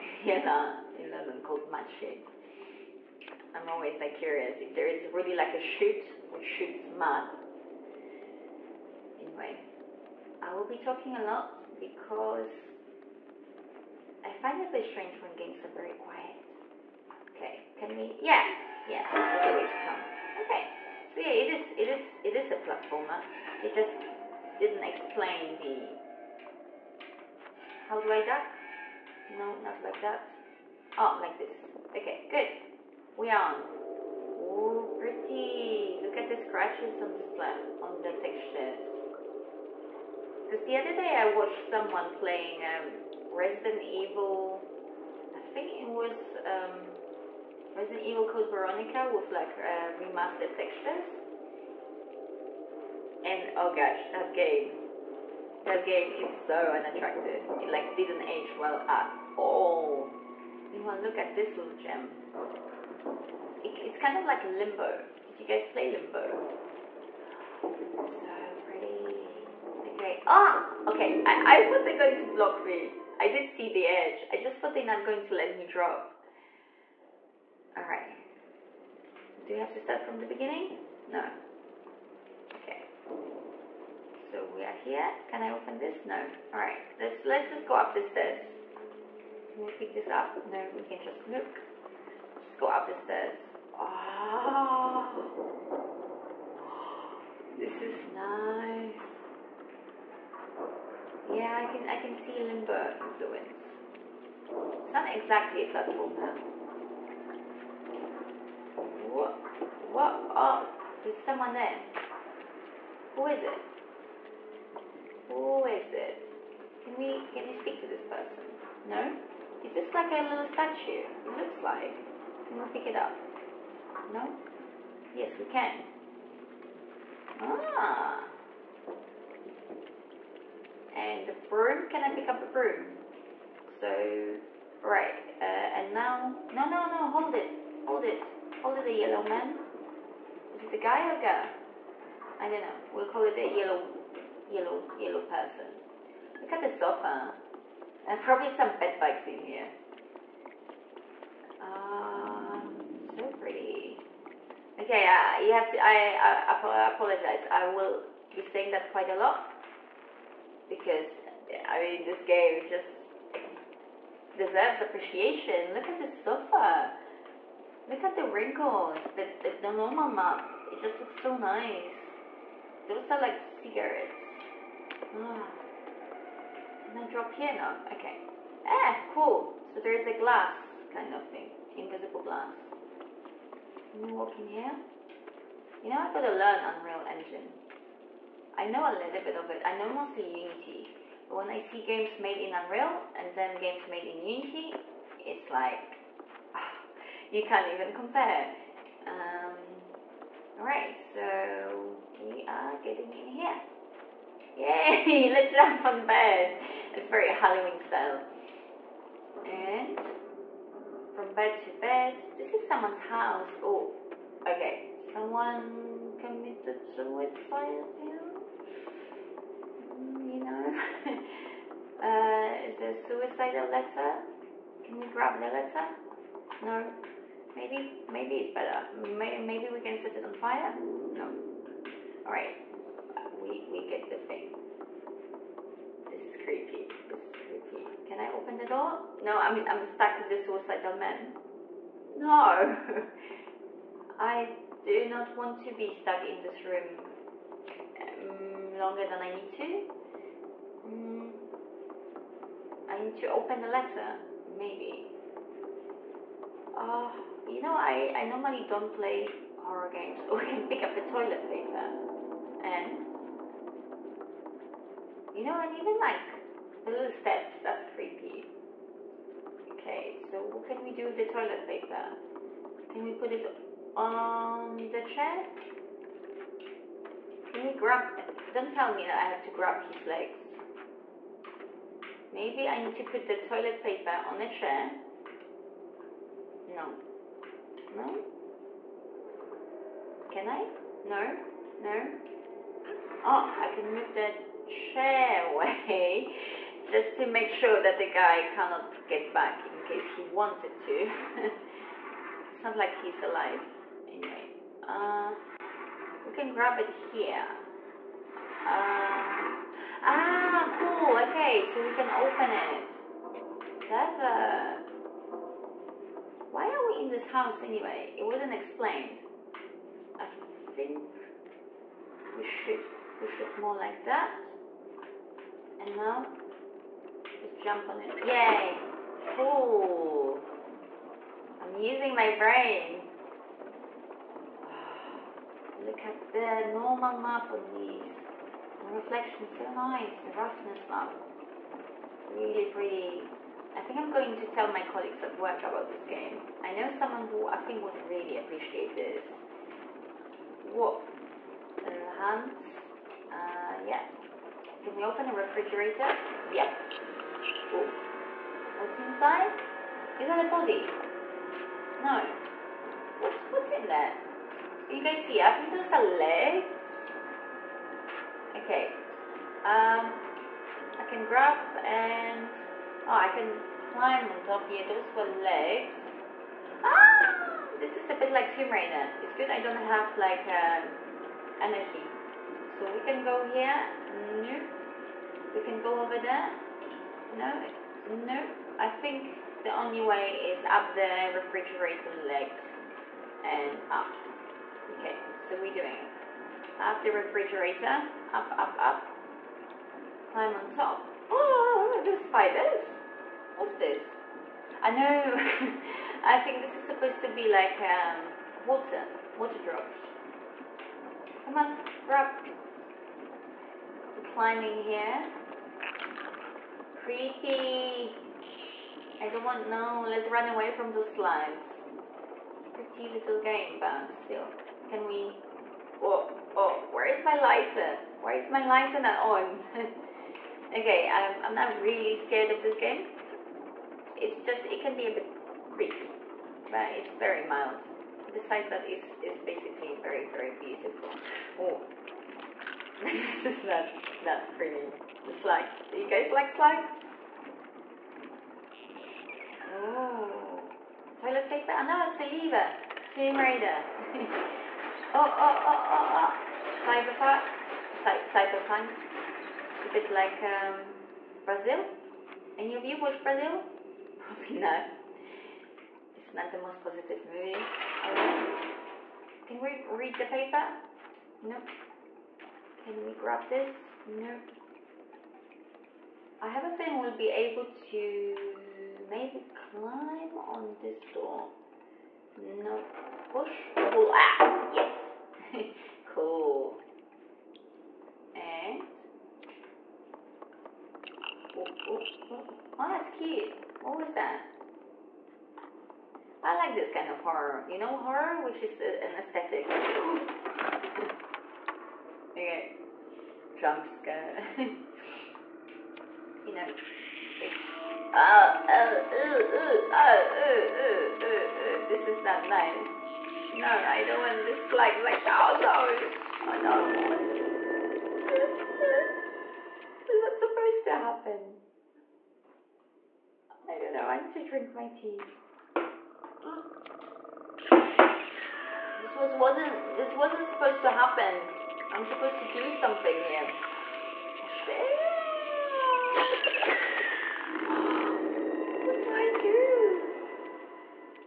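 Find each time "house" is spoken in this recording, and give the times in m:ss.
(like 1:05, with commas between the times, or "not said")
3:33, 5:17.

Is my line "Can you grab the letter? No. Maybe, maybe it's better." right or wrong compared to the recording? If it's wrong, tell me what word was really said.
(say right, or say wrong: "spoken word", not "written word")
right.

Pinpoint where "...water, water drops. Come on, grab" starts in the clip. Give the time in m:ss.
6:48.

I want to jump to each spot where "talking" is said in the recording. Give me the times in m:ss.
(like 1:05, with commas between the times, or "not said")
0:10.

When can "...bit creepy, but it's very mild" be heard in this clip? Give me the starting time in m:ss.
7:15.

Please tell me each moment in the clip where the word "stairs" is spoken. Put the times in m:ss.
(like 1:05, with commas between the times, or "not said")
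1:28, 1:32.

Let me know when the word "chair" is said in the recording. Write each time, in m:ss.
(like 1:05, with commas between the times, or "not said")
4:35, 4:44, 4:54.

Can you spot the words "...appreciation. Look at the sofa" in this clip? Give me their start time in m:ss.
2:44.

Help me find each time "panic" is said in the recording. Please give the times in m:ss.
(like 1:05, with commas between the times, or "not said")
not said.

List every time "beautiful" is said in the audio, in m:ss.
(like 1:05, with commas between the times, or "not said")
7:20.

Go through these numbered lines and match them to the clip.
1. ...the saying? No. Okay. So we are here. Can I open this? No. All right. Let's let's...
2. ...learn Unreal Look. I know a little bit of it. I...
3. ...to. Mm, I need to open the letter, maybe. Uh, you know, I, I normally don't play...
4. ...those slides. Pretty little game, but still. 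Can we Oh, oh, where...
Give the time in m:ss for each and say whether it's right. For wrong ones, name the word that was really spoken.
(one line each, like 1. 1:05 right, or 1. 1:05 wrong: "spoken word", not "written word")
1. 1:20 wrong: "beginning", not "saying"
2. 3:06 wrong: "Engine", not "Look"
3. 4:09 right
4. 7:00 right.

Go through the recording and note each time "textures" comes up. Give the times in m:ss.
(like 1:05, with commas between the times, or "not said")
0:38, 0:50.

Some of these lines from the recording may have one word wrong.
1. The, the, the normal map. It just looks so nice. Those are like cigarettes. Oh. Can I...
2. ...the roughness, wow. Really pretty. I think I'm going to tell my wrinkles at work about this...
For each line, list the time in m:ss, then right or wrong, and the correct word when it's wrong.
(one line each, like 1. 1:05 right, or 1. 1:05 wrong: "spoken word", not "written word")
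1. 2:49 right
2. 5:40 wrong: "colleagues", not "wrinkles".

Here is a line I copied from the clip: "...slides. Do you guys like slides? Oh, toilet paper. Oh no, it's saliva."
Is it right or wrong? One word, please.
right.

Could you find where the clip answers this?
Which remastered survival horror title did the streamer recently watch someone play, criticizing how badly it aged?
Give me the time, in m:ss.
0:47.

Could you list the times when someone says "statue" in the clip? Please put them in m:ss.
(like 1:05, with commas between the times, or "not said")
2:00.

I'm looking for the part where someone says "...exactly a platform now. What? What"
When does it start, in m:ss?
1:45.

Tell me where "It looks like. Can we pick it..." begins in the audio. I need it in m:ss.
2:01.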